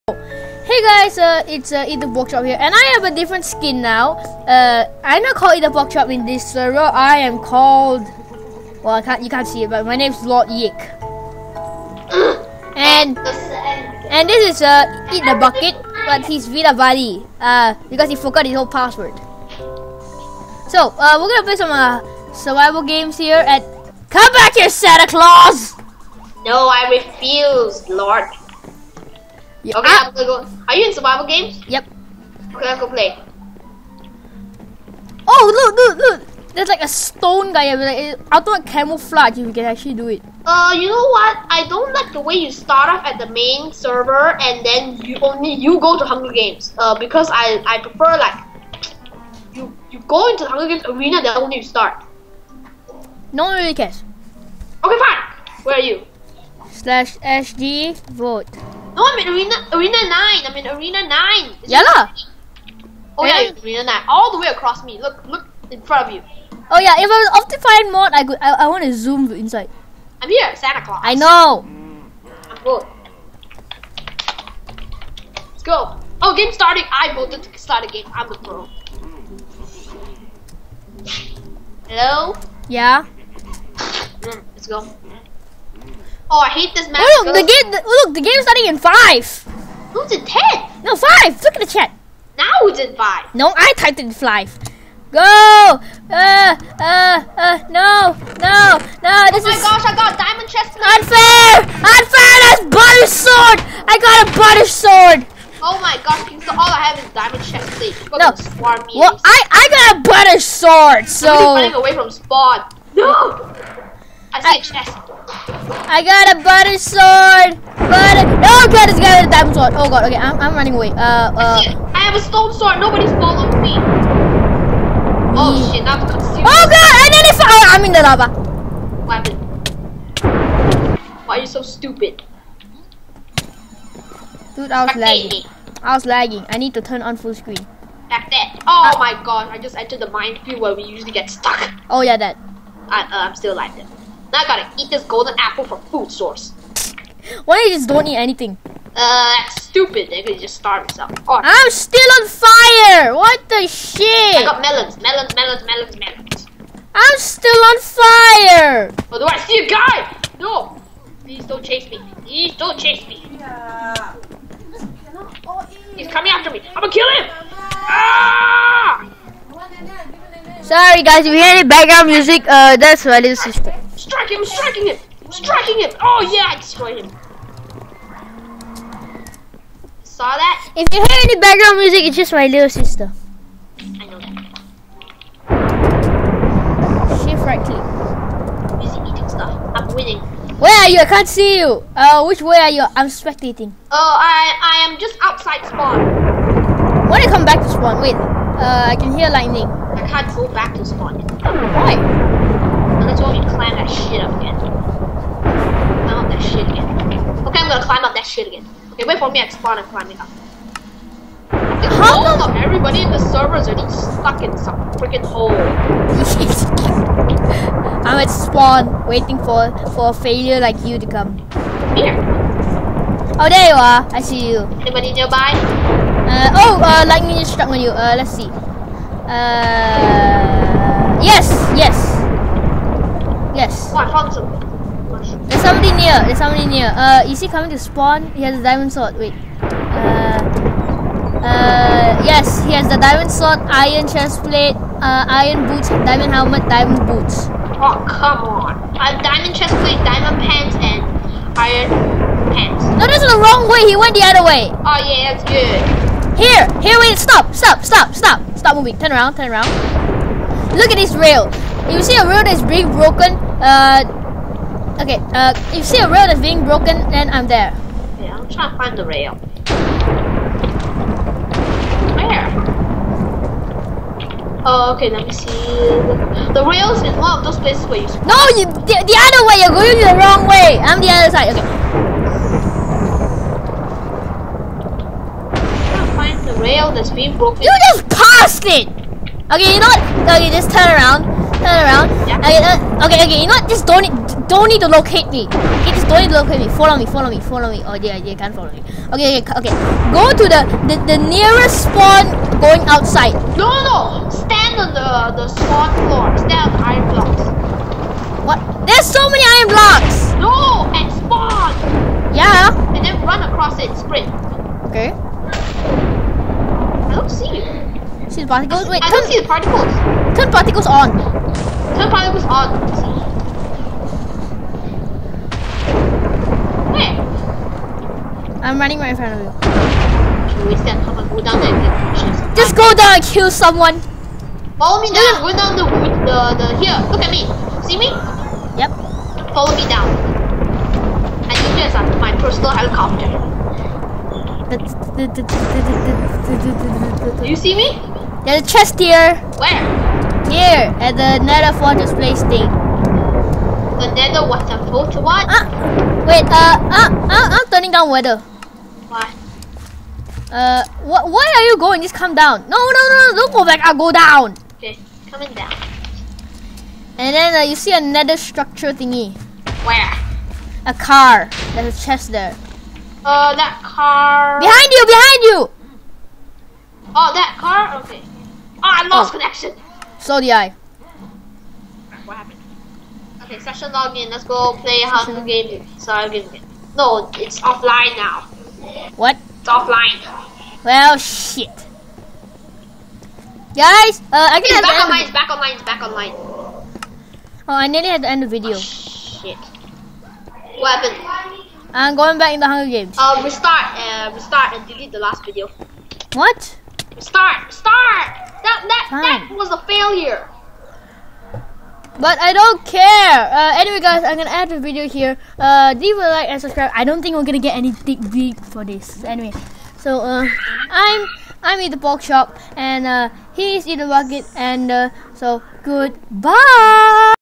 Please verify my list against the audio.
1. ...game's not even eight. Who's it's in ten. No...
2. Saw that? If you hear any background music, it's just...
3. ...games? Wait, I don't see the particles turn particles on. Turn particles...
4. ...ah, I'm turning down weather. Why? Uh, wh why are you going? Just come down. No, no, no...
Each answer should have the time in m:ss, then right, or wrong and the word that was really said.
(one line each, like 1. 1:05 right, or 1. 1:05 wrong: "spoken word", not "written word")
1. 1:28 wrong: "five", not "eight"
2. 3:00 right
3. 5:18 wrong: "particles", not "games"
4. 5:57 right.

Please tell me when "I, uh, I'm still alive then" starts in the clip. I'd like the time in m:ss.
2:22.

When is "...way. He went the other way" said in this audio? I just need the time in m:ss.
4:13.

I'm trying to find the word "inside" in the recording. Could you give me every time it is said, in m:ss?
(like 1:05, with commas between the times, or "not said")
1:09.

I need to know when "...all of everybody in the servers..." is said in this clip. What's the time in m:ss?
3:32.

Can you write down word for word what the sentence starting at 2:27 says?
Why you just don't eat anything?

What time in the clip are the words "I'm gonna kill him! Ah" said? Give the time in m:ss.
2:46.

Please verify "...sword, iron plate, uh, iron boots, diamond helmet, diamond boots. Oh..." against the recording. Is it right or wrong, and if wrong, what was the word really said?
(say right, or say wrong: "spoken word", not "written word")
right.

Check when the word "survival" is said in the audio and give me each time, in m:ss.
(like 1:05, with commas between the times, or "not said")
0:22, 0:30.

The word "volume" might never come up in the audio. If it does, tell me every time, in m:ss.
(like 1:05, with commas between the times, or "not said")
not said.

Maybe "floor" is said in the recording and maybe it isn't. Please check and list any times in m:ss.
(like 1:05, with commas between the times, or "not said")
5:06.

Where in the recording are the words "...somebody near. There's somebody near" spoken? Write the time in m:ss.
3:55.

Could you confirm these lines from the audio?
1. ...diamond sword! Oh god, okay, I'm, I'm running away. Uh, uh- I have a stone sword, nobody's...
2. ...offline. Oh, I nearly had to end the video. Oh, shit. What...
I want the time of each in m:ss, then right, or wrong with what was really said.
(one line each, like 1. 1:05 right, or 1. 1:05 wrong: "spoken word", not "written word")
1. 1:59 right
2. 6:36 wrong: "online", not "offline".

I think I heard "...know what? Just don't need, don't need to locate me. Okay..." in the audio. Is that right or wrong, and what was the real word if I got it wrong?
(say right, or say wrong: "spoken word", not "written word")
right.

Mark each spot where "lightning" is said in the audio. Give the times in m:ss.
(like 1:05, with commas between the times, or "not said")
3:19, 3:47.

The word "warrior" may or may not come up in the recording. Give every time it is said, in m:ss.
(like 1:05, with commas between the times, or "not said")
not said.